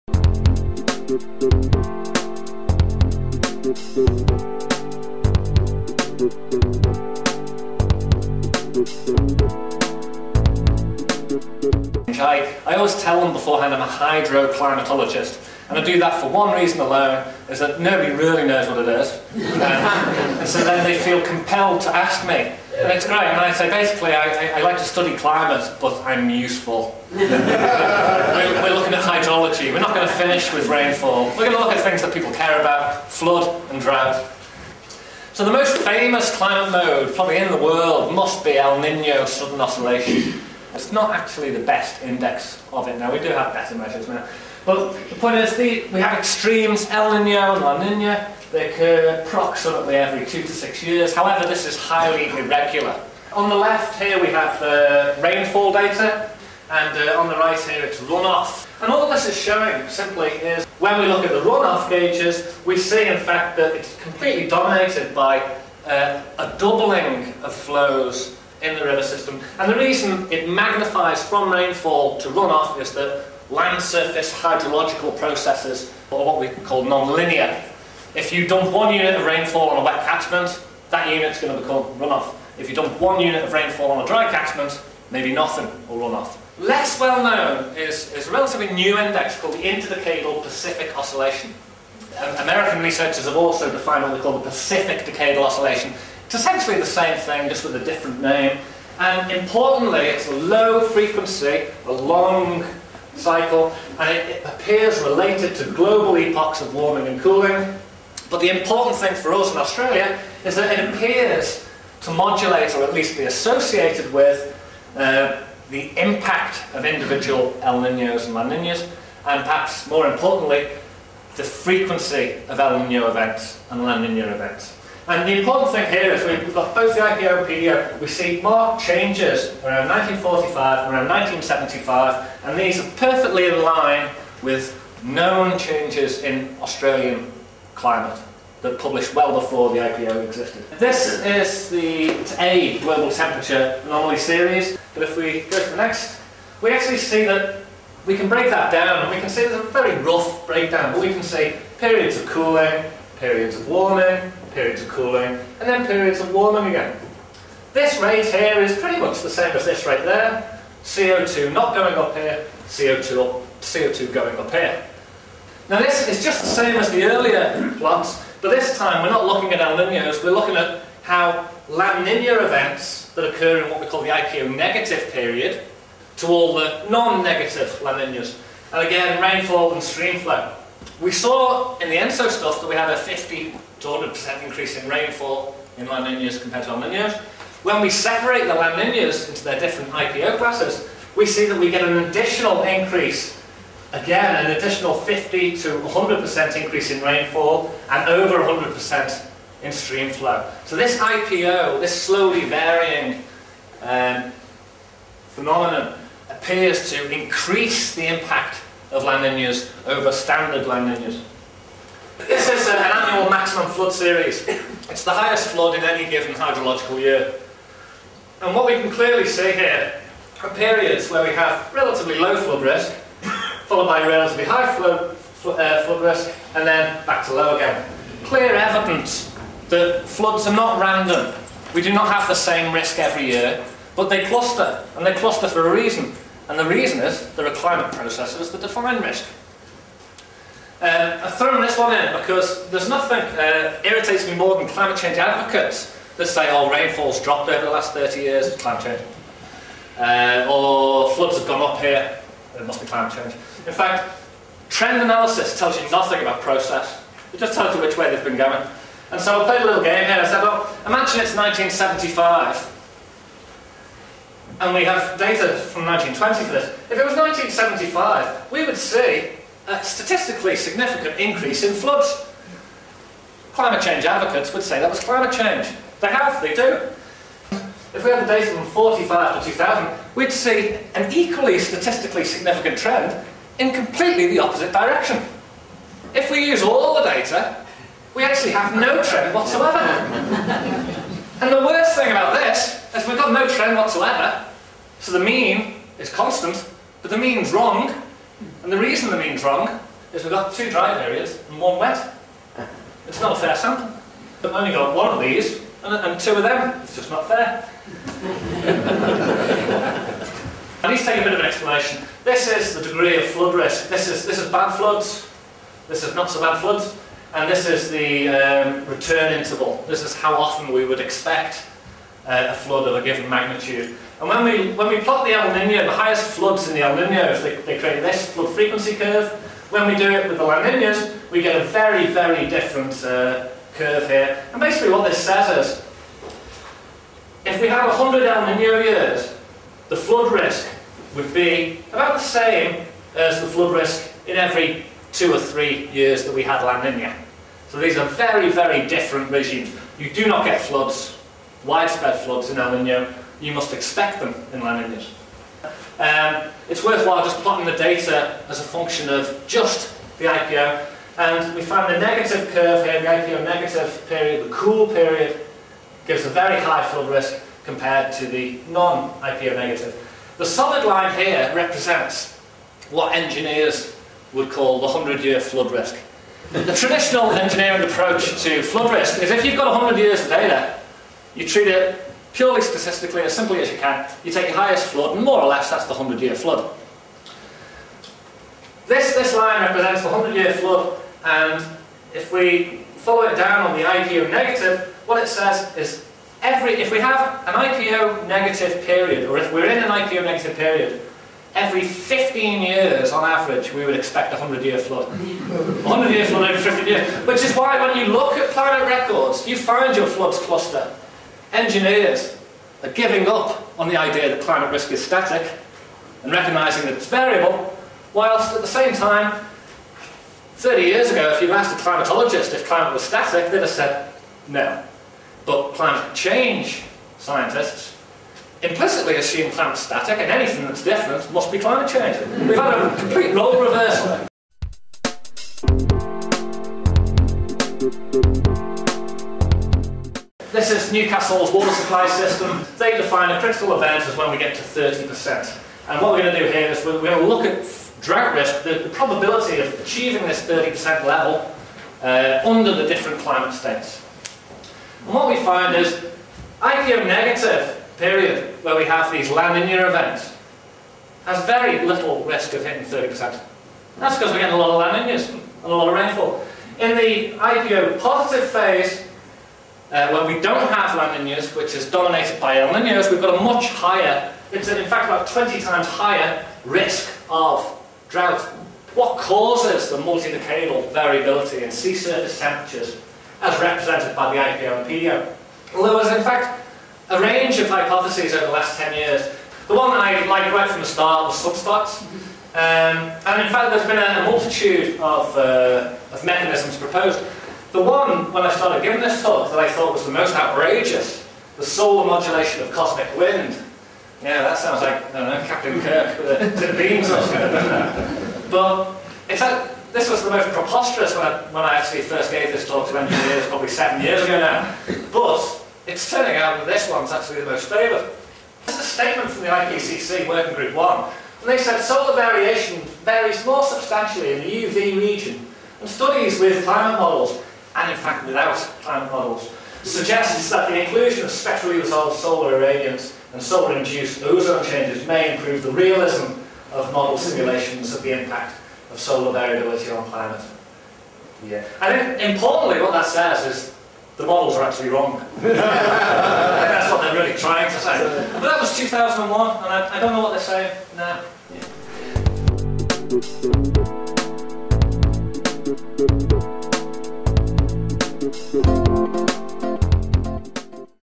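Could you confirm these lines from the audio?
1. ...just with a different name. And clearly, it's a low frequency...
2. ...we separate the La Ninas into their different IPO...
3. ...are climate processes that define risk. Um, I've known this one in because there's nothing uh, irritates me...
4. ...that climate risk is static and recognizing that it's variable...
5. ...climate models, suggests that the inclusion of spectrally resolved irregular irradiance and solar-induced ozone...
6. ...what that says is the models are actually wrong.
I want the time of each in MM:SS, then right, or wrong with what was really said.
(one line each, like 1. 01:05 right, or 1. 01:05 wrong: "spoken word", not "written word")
1. 01:37 wrong: "importantly", not "clearly"
2. 03:07 right
3. 03:57 wrong: "thrown", not "known"
4. 06:54 right
5. 08:48 wrong: "solar", not "irregular"
6. 09:02 right.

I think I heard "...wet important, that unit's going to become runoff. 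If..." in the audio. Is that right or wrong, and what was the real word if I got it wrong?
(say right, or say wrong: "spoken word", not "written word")
wrong: "catchment", not "important".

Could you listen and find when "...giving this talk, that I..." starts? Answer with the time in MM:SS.
08:18.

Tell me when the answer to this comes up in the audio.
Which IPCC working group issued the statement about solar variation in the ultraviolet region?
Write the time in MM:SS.
08:40.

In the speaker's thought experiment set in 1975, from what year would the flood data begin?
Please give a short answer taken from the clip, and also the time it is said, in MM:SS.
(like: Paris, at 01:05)
1920, at 04:25.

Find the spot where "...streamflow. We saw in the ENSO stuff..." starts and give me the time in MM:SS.
02:59.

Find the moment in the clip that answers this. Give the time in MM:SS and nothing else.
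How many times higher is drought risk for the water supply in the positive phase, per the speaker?
07:55.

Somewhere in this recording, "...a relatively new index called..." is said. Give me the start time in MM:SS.
01:28.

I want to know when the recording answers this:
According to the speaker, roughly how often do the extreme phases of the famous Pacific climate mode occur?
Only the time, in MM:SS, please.
00:49.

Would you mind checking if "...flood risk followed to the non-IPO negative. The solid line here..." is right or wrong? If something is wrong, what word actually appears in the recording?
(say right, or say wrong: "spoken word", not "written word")
wrong: "compared", not "followed".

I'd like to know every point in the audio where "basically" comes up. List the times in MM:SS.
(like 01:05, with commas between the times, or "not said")
00:23, 05:34.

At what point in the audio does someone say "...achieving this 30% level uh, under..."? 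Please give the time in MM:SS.
07:29.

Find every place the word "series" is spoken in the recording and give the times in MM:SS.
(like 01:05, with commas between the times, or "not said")
02:24, 03:33.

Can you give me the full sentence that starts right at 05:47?
So these are very, very different regimes.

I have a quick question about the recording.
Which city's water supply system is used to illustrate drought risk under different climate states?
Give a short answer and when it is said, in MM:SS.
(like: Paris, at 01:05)
Newcastle, at 07:20.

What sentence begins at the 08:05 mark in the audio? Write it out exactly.
Well, there was, in fact, a range of hypotheses over the last 10 years.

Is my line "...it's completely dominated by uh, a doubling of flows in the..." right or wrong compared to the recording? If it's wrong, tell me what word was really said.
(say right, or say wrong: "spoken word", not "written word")
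right.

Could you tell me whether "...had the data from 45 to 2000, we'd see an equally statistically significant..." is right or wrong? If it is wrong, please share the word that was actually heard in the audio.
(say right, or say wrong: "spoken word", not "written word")
right.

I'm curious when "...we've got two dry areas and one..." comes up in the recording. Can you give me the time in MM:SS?
05:00.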